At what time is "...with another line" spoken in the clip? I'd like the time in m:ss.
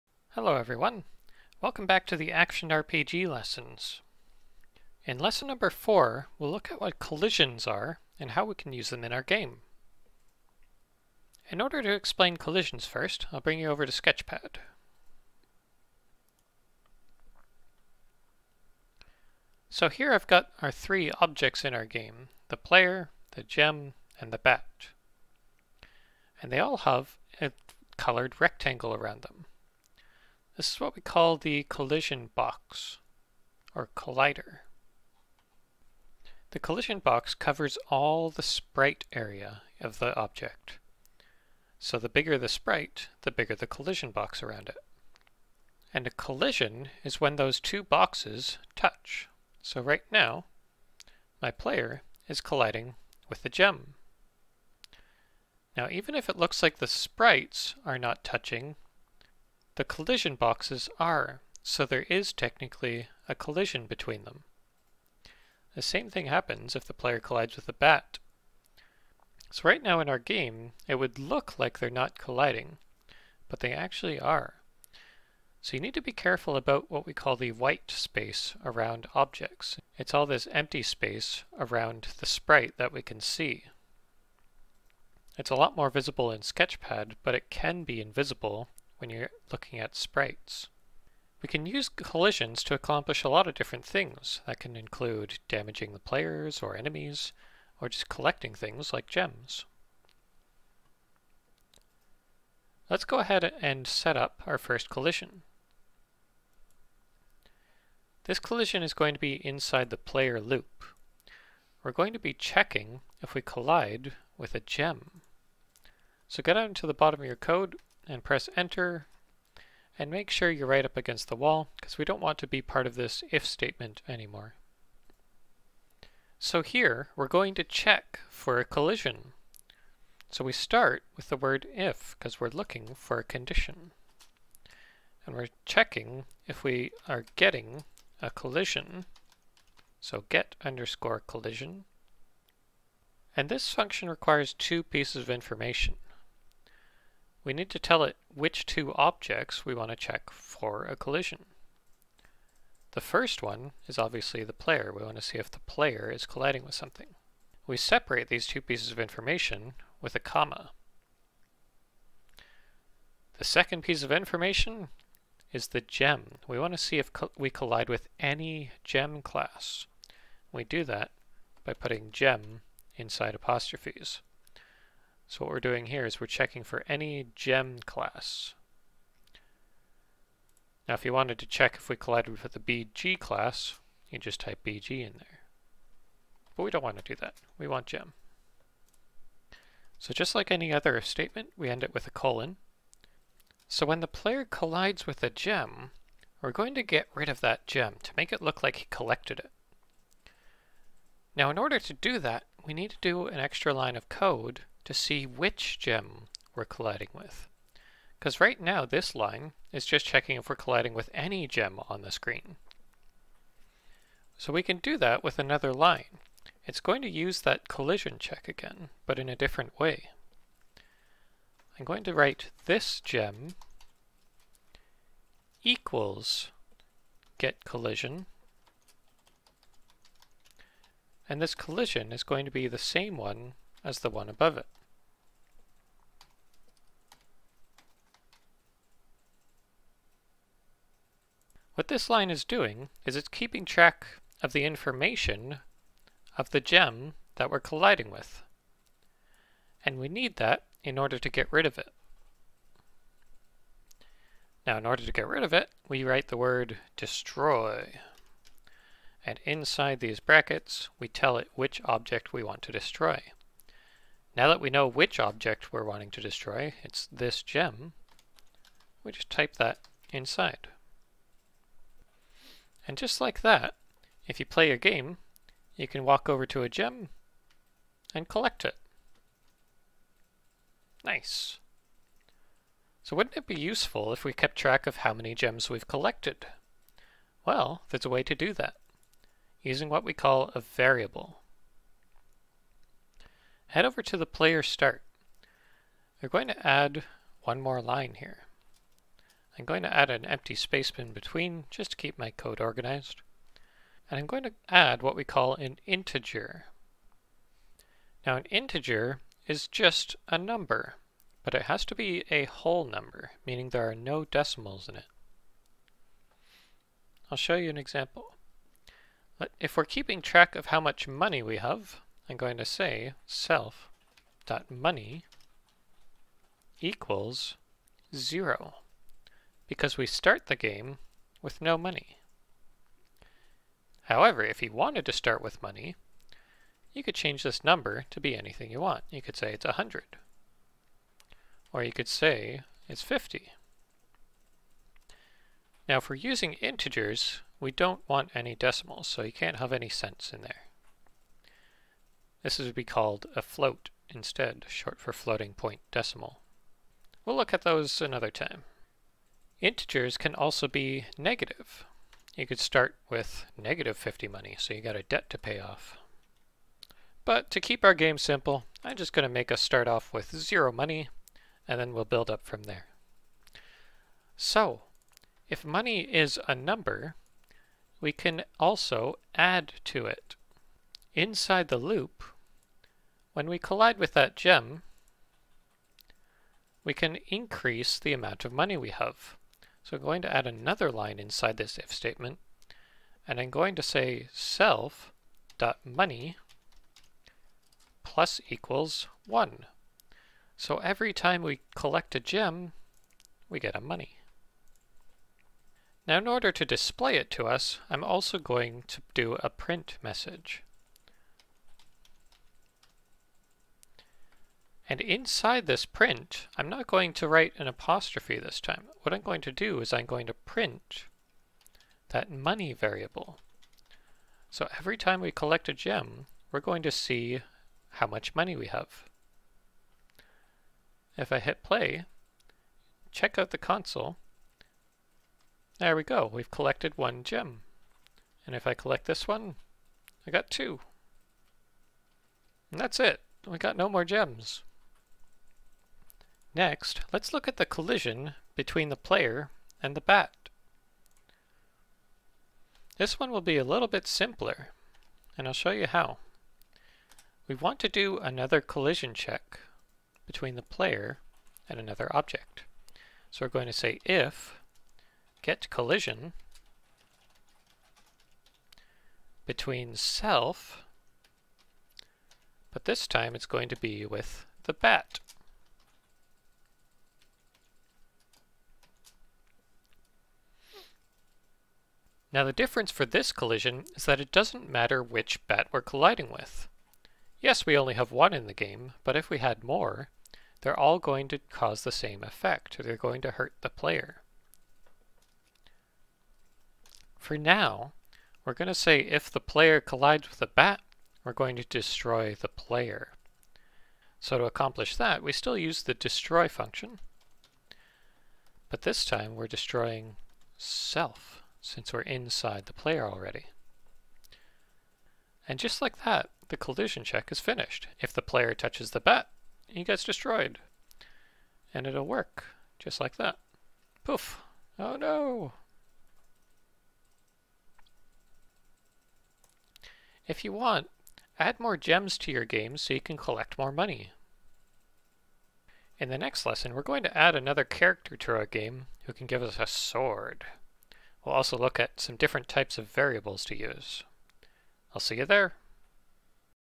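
3:35.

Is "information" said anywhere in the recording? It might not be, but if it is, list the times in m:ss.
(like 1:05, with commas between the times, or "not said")
2:25, 2:38, 2:44, 4:04.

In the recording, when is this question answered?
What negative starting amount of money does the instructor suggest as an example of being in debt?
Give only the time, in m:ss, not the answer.
6:03.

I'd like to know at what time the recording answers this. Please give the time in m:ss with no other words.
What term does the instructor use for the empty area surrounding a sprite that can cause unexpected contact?
1:17.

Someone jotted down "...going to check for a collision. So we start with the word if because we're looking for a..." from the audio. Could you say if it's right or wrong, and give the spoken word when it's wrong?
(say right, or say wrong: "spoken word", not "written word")
right.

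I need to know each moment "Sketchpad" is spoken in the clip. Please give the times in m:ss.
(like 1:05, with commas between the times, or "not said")
0:13, 1:26.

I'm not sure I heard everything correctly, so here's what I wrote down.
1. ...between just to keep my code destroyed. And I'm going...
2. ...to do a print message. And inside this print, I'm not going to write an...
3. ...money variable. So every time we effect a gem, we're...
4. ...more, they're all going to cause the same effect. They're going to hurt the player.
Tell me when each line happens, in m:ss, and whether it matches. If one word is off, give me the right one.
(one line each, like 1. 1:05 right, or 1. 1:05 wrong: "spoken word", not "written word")
1. 5:01 wrong: "organized", not "destroyed"
2. 6:48 right
3. 7:02 wrong: "collect", not "effect"
4. 8:09 right.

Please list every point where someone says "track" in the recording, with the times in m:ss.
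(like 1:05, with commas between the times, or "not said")
4:03, 4:44, 5:20.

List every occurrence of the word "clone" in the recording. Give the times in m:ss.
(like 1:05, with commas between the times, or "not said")
not said.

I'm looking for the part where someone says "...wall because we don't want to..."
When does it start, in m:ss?
2:01.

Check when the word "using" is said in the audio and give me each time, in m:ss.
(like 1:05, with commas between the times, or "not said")
4:49, 5:46.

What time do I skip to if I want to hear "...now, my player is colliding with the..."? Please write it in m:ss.
0:50.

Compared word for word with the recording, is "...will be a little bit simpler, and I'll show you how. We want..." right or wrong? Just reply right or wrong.
right.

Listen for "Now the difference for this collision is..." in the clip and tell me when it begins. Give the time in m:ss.
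8:02.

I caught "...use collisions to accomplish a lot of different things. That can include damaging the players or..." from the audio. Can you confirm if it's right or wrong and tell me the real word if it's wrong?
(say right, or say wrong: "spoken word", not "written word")
right.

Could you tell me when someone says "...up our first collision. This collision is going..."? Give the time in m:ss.
1:44.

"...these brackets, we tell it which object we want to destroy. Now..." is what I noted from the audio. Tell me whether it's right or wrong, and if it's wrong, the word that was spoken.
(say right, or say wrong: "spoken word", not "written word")
right.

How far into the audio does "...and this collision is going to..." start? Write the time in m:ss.
3:51.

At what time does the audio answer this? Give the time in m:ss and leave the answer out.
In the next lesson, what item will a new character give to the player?
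8:59.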